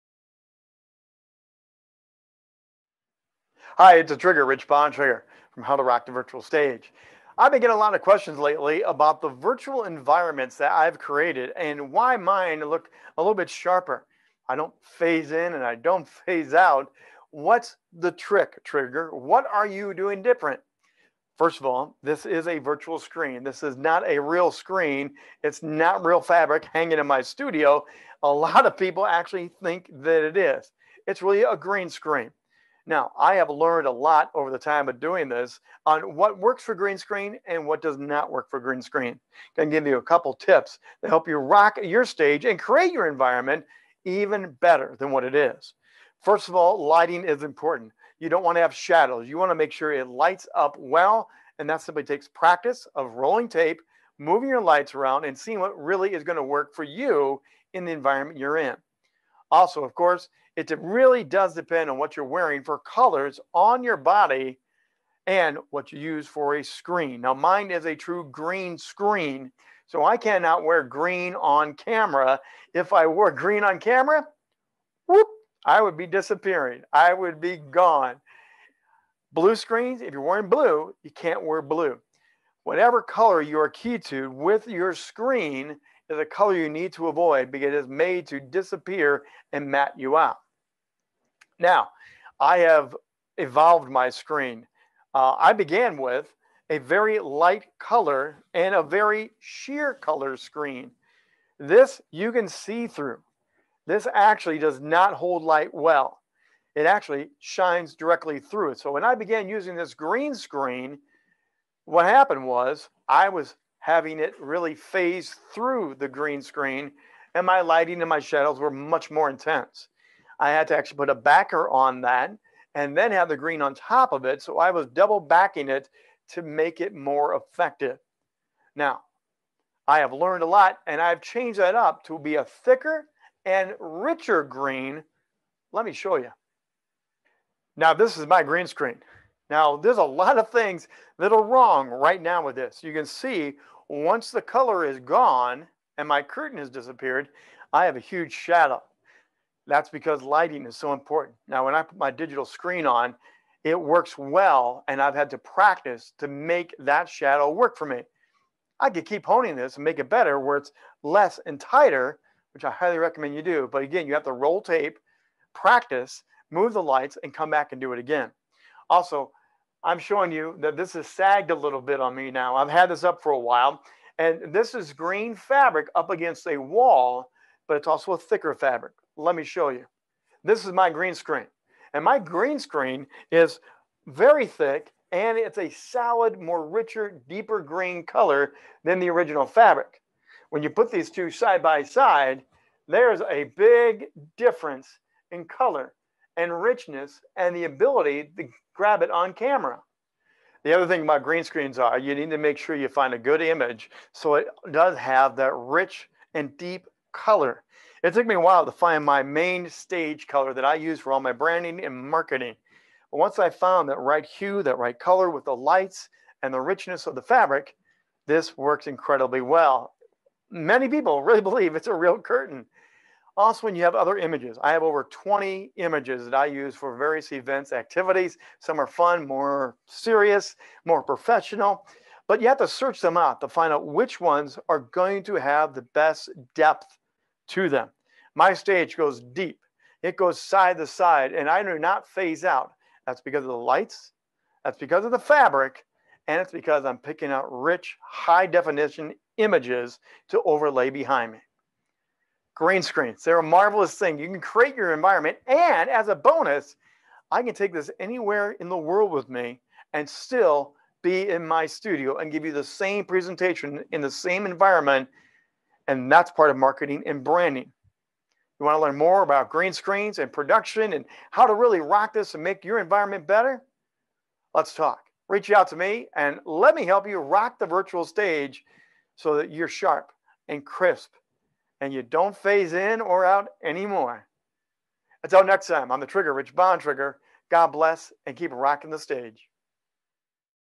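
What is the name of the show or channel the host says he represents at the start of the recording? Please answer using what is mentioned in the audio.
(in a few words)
How to Rock the Virtual Stage.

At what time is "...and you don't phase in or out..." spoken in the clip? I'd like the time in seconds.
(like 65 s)
281 s.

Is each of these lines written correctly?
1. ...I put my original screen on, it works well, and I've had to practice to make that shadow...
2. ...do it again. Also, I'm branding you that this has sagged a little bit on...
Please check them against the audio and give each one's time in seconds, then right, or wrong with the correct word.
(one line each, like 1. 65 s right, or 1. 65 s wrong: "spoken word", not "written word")
1. 151 s wrong: "digital", not "original"
2. 167 s wrong: "showing", not "branding".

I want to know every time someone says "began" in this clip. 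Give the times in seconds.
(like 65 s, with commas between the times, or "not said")
95 s, 109 s.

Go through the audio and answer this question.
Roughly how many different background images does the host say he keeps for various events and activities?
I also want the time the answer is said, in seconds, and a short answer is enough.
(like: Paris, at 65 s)
Over 20, at 224 s.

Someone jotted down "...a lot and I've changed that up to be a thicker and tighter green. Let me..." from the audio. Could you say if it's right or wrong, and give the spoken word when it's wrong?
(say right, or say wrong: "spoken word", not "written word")
wrong: "richer", not "tighter".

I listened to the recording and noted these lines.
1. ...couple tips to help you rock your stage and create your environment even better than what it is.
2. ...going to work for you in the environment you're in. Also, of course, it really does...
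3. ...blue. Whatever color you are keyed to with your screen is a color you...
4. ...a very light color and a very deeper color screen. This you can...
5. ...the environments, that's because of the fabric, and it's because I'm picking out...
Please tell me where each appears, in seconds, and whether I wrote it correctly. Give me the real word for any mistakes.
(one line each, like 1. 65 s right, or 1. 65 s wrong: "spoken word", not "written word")
1. 40 s right
2. 56 s right
3. 81 s right
4. 96 s wrong: "sheer", not "deeper"
5. 243 s wrong: "lights", not "environments".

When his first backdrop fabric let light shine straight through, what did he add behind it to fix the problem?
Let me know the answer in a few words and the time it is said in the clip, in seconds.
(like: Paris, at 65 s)
A backer, at 121 s.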